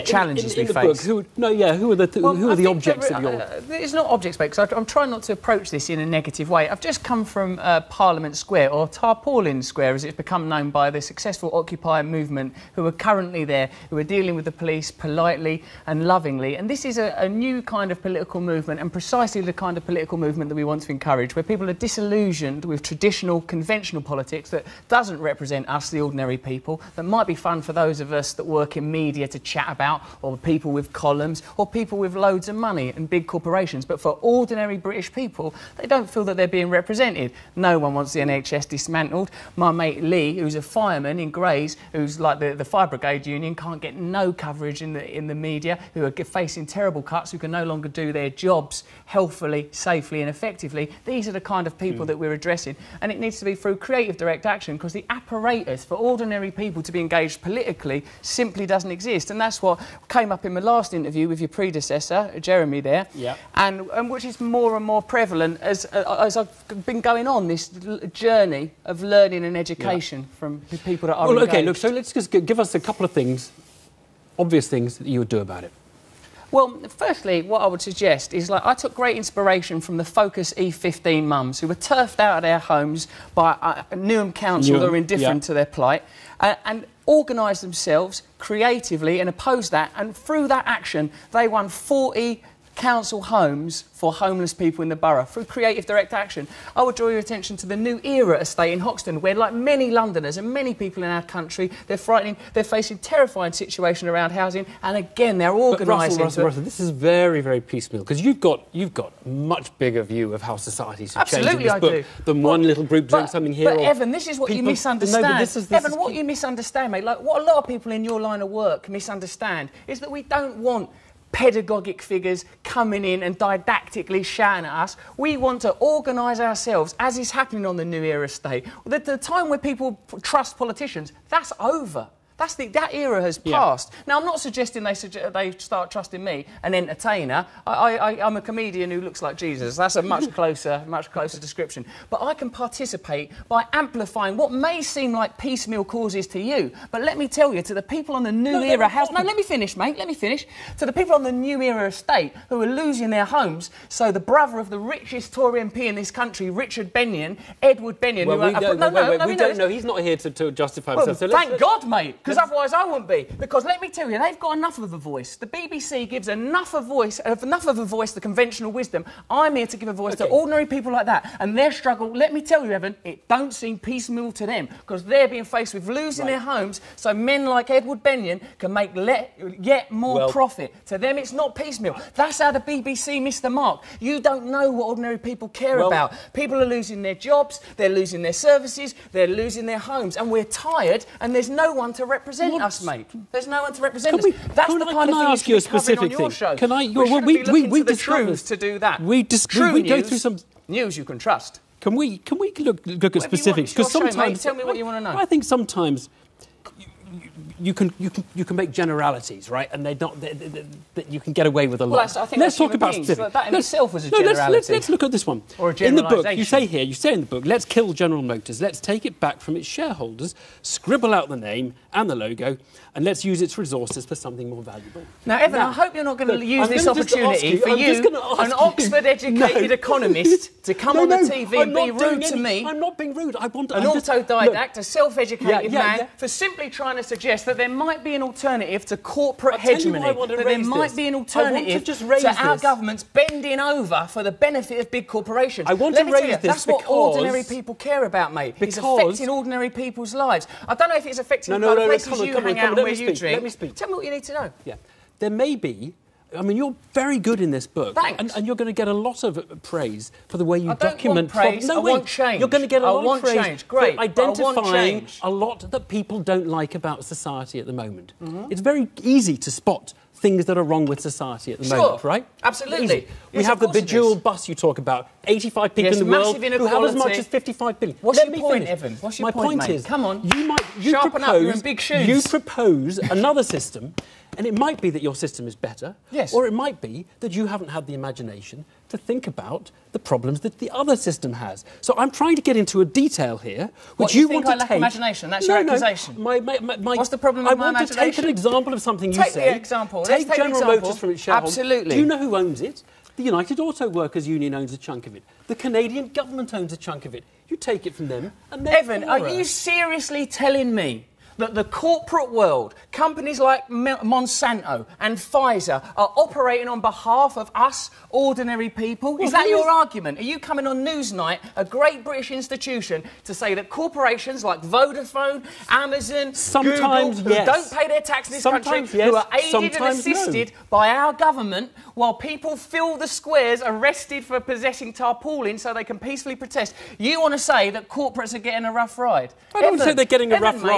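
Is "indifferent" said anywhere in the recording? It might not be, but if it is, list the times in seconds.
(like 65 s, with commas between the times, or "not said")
84 s.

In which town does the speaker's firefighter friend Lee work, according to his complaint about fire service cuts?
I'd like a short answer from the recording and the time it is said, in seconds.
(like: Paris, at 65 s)
Grays, at 41 s.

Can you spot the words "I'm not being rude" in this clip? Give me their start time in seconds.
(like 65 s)
232 s.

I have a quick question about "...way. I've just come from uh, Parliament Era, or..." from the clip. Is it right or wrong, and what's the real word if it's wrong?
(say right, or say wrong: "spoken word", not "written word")
wrong: "Square", not "Era".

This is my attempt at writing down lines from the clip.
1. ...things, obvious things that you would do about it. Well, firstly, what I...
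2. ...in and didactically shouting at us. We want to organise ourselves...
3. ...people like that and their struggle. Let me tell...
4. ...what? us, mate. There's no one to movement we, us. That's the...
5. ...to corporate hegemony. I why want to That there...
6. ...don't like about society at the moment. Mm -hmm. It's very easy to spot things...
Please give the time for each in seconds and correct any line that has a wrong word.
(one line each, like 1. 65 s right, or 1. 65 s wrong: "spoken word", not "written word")
1. 73 s right
2. 123 s right
3. 170 s right
4. 192 s wrong: "represent", not "movement"
5. 238 s right
6. 266 s right.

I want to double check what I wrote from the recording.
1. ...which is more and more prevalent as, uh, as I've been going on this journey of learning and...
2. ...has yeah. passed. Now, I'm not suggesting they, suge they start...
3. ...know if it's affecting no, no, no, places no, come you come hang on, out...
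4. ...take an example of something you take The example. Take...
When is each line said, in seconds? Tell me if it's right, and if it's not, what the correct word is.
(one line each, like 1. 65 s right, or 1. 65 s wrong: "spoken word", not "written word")
1. 64 s right
2. 133 s right
3. 250 s right
4. 297 s right.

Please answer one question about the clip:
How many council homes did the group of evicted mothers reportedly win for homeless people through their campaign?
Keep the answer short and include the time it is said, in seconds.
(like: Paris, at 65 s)
40, at 91 s.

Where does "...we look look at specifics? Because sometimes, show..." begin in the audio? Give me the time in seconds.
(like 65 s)
202 s.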